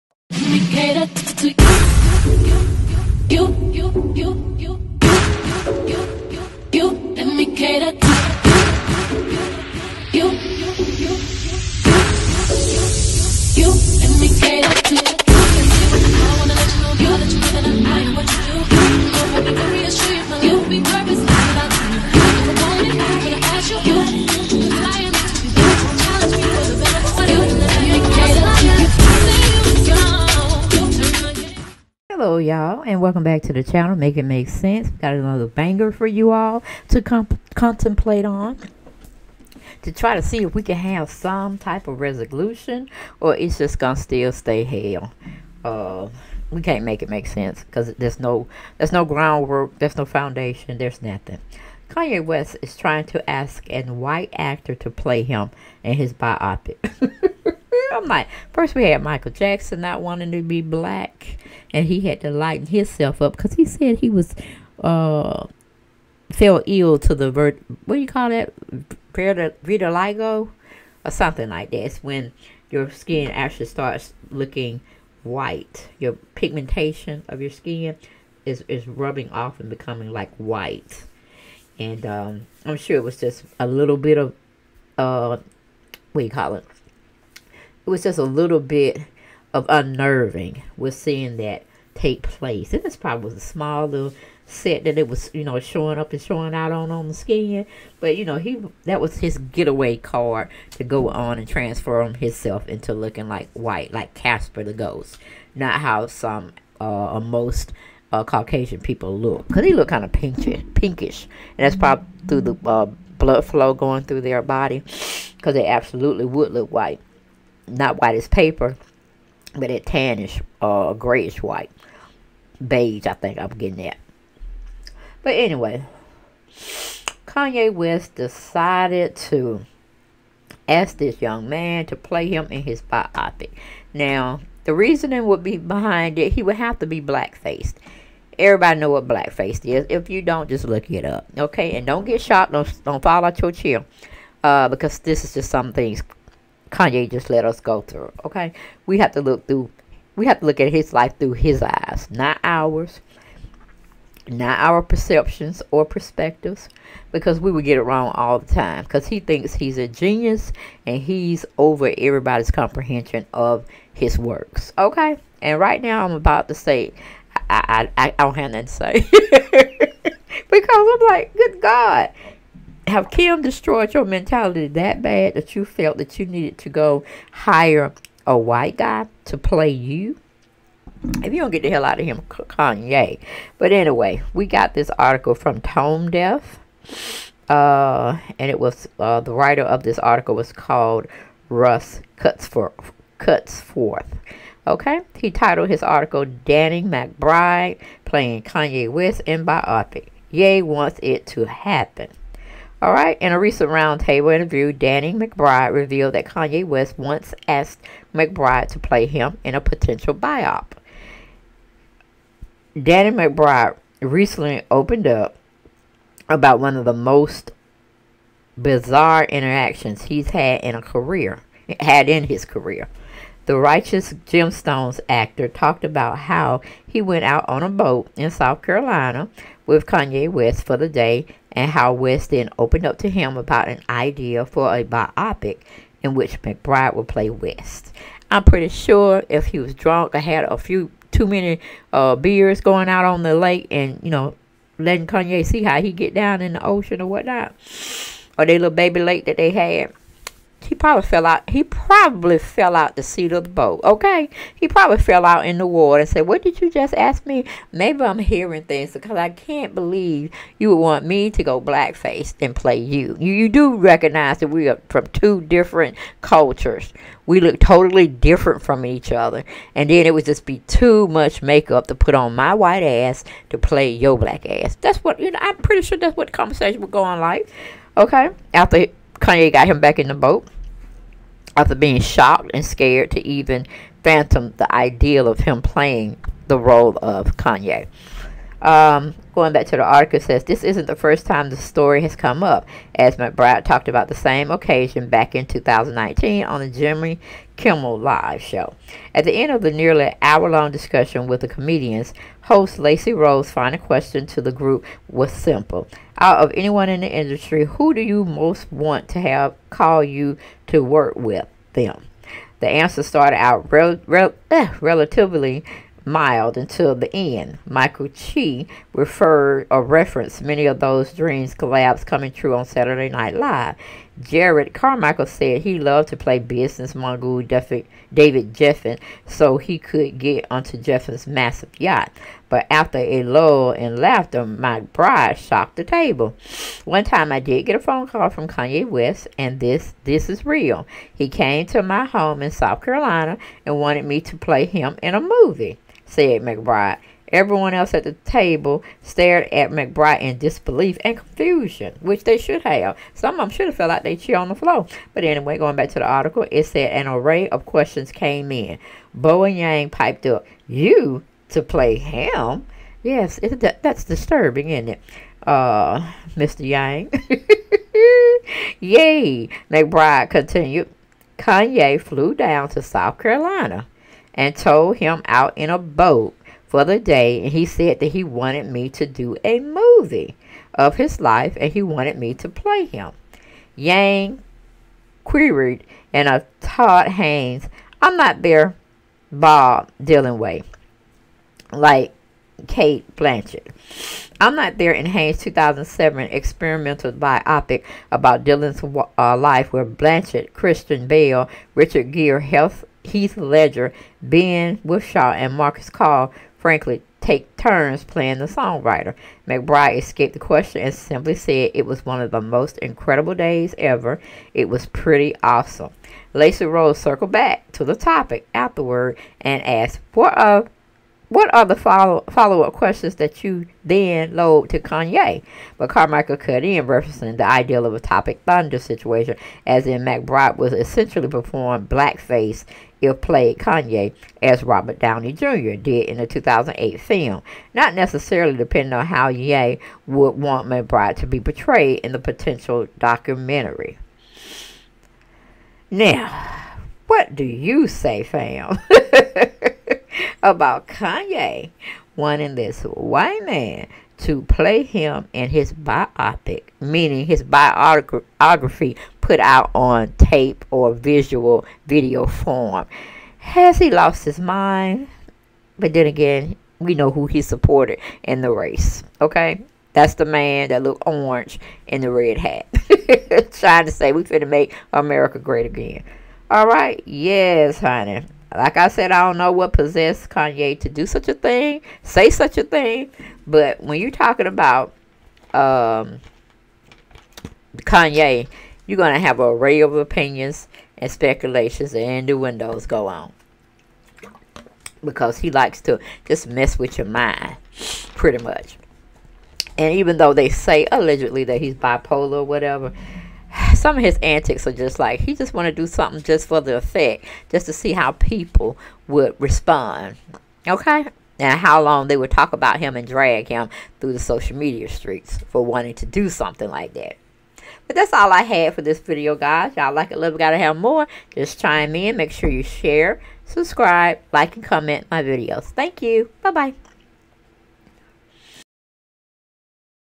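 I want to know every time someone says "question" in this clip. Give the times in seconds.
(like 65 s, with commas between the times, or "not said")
303 s, 357 s, 410 s, 422 s.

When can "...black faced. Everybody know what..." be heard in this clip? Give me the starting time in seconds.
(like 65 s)
136 s.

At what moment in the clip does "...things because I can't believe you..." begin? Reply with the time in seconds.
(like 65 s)
258 s.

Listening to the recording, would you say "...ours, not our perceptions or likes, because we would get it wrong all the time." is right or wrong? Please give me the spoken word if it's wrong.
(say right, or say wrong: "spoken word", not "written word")
wrong: "perspectives", not "likes".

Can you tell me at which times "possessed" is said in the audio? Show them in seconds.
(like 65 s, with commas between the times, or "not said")
479 s.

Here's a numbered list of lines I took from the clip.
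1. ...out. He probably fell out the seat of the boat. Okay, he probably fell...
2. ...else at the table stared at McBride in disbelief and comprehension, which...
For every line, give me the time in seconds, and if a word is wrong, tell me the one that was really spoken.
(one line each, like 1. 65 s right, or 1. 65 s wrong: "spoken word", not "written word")
1. 251 s right
2. 347 s wrong: "confusion", not "comprehension".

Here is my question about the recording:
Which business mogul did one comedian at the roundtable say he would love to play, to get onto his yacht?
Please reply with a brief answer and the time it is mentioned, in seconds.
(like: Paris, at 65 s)
David Geffen, at 327 s.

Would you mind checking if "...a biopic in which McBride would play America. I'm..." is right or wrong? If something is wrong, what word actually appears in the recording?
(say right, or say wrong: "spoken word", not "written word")
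wrong: "West", not "America".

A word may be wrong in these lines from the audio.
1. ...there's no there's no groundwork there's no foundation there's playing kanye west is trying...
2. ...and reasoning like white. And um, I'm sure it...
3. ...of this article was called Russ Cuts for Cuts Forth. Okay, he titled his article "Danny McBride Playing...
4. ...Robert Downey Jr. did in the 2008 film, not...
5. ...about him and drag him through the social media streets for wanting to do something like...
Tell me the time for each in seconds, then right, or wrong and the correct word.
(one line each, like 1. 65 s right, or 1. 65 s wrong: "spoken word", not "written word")
1. 47 s wrong: "nothing", not "playing"
2. 79 s wrong: "becoming", not "reasoning"
3. 189 s right
4. 434 s right
5. 512 s right.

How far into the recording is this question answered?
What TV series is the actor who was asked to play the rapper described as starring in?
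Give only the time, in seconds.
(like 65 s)
223 s.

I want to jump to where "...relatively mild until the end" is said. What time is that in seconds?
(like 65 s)
314 s.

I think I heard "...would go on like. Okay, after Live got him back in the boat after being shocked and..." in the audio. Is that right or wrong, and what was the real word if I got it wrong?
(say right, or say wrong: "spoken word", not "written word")
wrong: "Kanye", not "Live".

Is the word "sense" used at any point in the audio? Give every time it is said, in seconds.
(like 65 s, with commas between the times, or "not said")
34 s, 47 s.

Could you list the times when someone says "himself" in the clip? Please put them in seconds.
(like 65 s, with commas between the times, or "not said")
62 s, 102 s.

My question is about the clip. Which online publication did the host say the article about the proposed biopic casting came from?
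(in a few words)
Tone Deaf.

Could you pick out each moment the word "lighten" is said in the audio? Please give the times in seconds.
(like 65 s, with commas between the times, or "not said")
62 s.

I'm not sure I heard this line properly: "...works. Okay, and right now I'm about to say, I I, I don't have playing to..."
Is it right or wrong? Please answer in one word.
wrong.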